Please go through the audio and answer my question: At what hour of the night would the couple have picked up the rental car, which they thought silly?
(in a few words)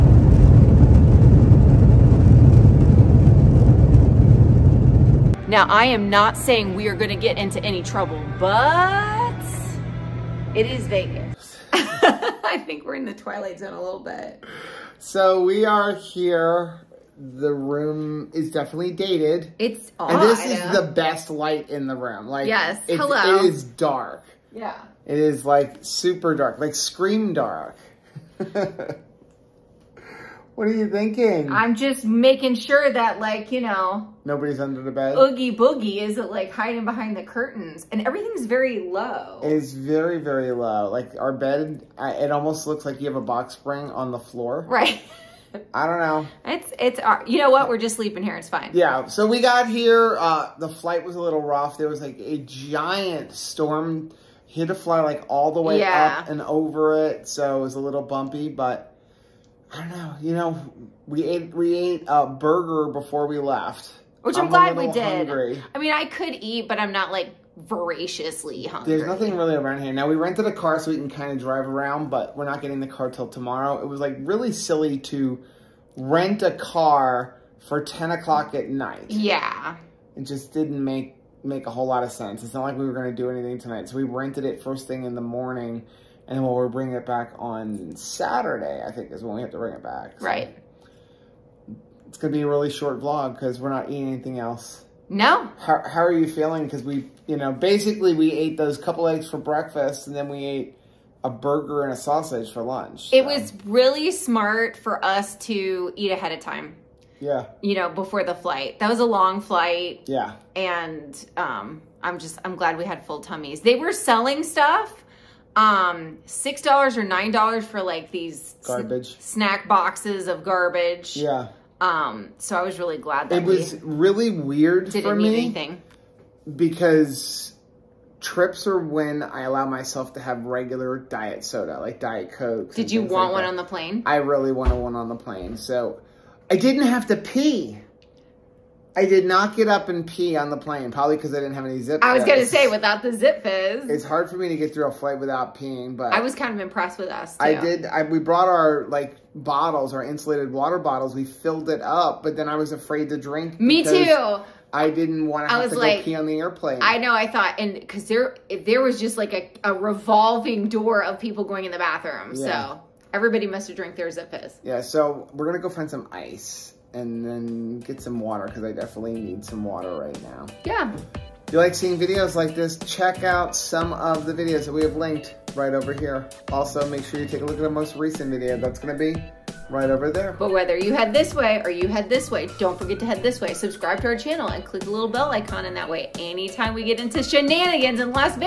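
10 o'clock.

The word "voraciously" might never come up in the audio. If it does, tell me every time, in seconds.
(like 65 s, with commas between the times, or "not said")
67 s.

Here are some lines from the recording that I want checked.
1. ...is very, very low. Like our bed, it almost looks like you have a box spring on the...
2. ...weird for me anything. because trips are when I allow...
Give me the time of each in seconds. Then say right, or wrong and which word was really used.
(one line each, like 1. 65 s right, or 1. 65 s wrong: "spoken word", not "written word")
1. 39 s right
2. 124 s right.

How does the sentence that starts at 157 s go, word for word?
I thought, and because there, there was just like a, a revolving door of people going in the bathroom.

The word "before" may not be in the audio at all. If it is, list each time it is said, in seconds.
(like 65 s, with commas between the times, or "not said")
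62 s, 107 s.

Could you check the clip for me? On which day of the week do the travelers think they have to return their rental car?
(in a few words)
Saturday.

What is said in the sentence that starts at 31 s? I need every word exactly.
I'm just making sure that like, you know.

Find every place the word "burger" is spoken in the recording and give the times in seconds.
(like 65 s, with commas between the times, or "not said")
62 s, 101 s.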